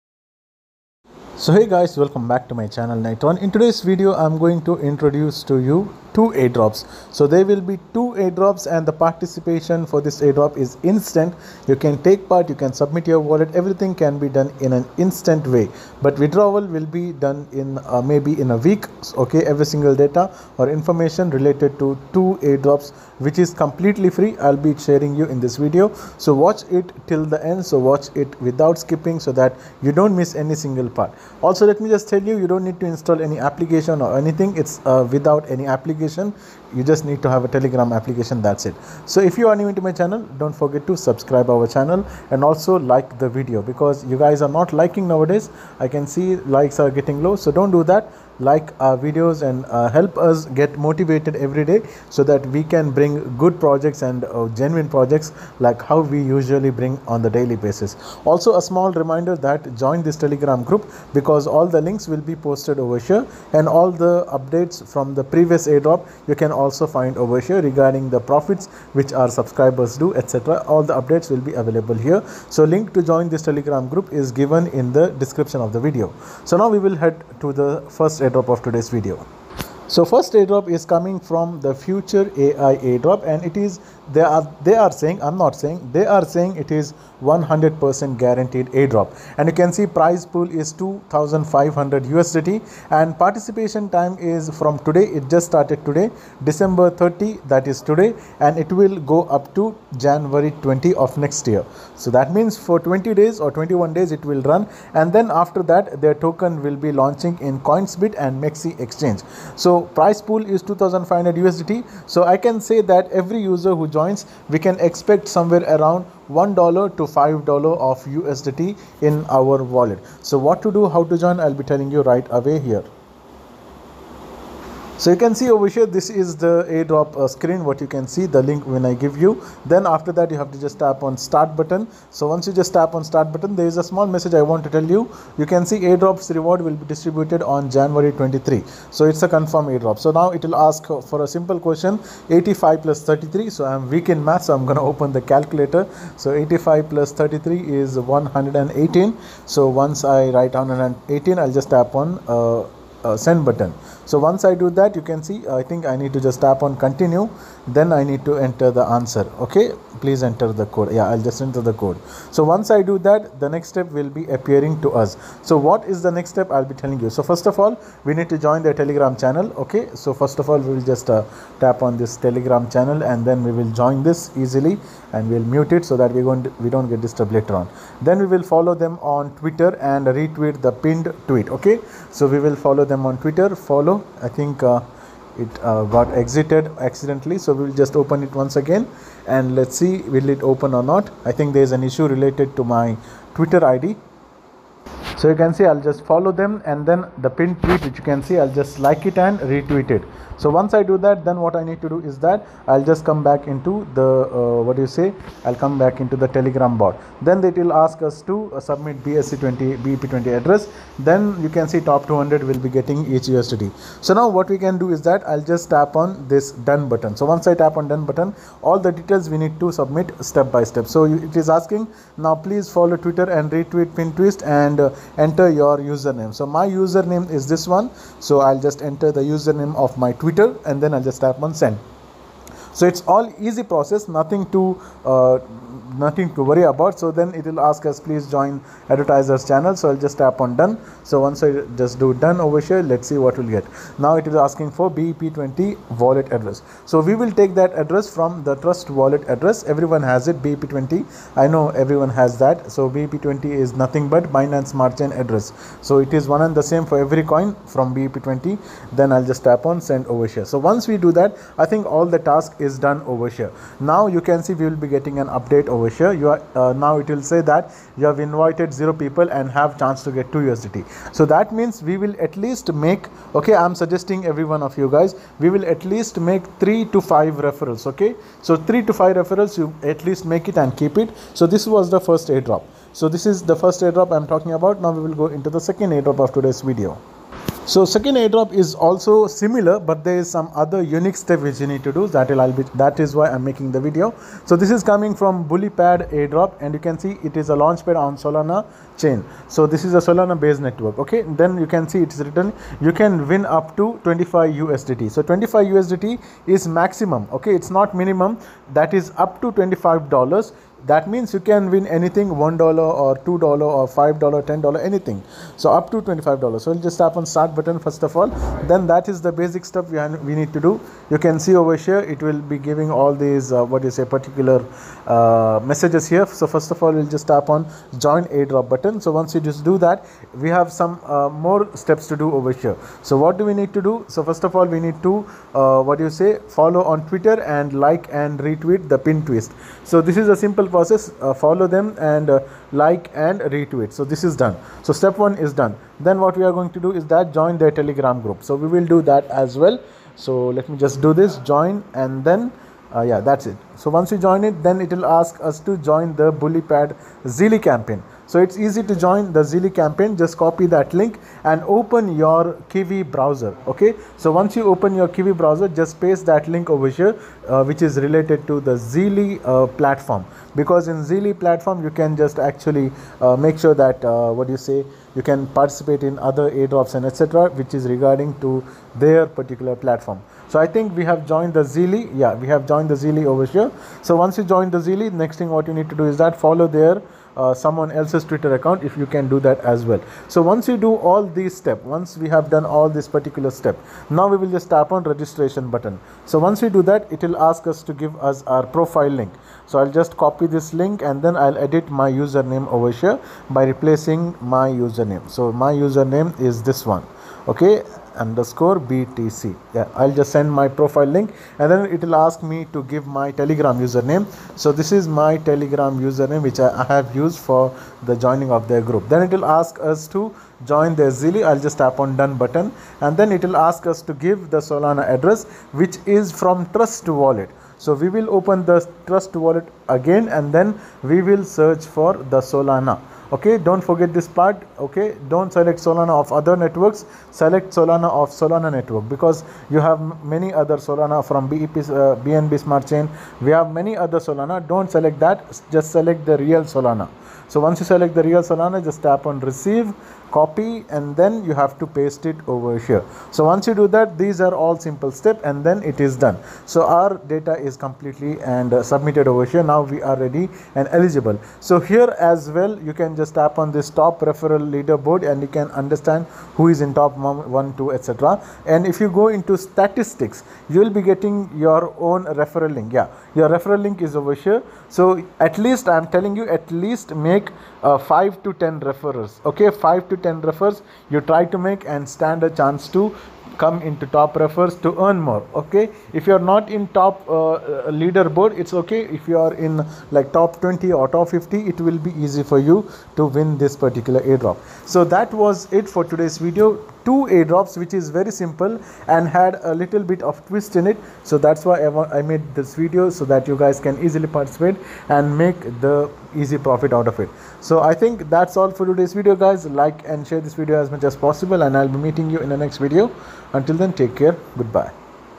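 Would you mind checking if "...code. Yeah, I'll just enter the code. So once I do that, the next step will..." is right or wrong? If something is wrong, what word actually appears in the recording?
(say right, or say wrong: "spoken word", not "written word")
right.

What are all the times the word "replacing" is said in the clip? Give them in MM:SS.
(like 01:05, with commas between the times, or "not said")
06:43.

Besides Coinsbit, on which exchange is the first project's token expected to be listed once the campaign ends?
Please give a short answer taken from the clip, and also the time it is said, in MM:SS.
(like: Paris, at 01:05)
MEXC, at 01:48.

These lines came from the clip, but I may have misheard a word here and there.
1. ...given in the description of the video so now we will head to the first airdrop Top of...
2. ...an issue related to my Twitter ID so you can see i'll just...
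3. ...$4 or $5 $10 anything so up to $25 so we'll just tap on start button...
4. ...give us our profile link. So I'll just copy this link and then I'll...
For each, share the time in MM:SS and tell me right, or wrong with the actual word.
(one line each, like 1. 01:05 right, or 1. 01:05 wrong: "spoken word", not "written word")
1. 01:14 right
2. 03:11 right
3. 05:13 wrong: "2", not "4"
4. 06:37 right.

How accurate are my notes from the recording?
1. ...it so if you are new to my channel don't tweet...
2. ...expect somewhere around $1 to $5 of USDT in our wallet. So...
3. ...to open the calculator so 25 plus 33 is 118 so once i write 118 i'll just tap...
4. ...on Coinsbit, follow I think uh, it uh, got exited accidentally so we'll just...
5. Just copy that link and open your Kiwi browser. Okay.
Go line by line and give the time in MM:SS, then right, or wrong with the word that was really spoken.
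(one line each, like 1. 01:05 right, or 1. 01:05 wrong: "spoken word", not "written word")
1. 00:38 wrong: "forget", not "tweet"
2. 01:54 right
3. 02:24 wrong: "85", not "25"
4. 03:03 wrong: "Twitter", not "Coinsbit"
5. 06:00 right.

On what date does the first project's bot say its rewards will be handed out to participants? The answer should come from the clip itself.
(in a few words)
January 23.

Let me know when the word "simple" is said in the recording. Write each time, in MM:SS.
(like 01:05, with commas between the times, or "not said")
02:21, 05:40, 07:34, 08:18.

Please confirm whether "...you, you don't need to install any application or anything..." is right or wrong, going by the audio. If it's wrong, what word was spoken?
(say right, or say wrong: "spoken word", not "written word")
right.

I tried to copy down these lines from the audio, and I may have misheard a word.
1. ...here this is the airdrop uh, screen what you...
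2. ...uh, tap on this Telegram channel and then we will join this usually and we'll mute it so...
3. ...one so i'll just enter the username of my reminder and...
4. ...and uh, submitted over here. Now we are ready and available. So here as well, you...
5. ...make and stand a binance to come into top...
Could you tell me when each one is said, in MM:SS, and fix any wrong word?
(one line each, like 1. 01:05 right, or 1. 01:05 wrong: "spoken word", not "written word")
1. 02:05 right
2. 02:51 wrong: "easily", not "usually"
3. 03:47 wrong: "twitter", not "reminder"
4. 07:38 wrong: "eligible", not "available"
5. 08:01 wrong: "chance", not "binance".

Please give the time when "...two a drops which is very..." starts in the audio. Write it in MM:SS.
08:17.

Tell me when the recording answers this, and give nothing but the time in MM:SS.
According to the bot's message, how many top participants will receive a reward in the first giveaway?
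03:31.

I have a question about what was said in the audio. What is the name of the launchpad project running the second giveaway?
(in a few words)
BullyPad.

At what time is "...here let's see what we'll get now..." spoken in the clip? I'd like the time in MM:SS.
04:02.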